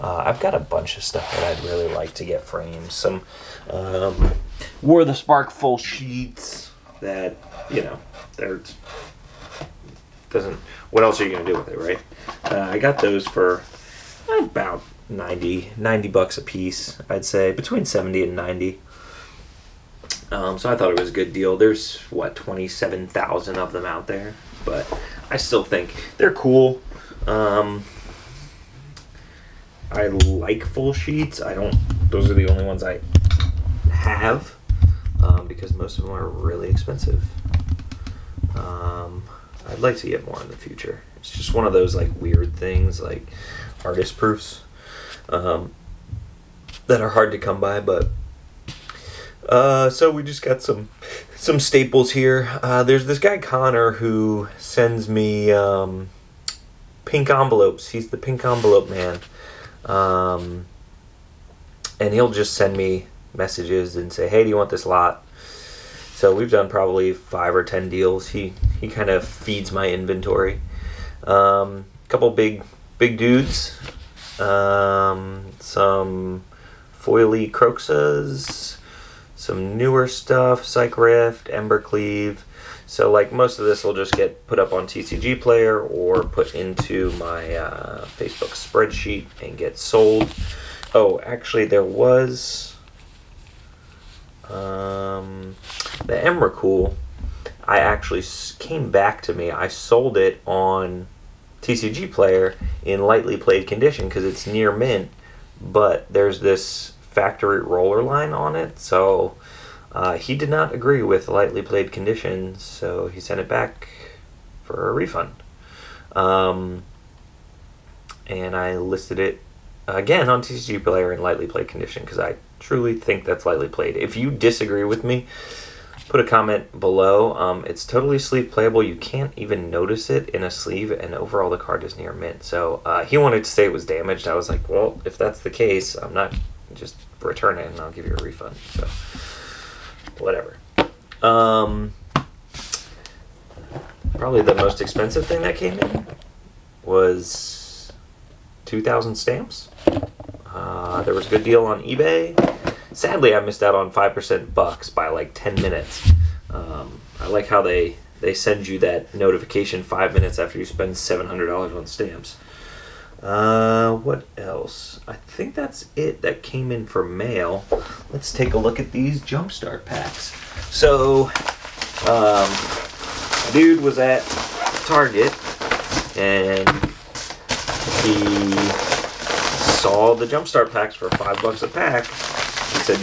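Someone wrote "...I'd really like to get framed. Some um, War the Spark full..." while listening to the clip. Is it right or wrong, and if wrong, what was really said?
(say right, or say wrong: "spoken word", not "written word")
right.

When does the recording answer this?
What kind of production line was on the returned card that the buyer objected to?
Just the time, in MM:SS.
01:47.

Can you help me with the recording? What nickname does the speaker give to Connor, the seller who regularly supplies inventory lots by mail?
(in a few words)
the pink envelope man.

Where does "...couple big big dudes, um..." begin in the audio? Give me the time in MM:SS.
01:12.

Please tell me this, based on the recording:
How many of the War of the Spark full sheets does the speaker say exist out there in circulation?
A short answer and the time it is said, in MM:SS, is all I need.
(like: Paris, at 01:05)
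27,000, at 00:22.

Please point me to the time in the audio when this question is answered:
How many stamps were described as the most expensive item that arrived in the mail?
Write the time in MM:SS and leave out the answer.
02:28.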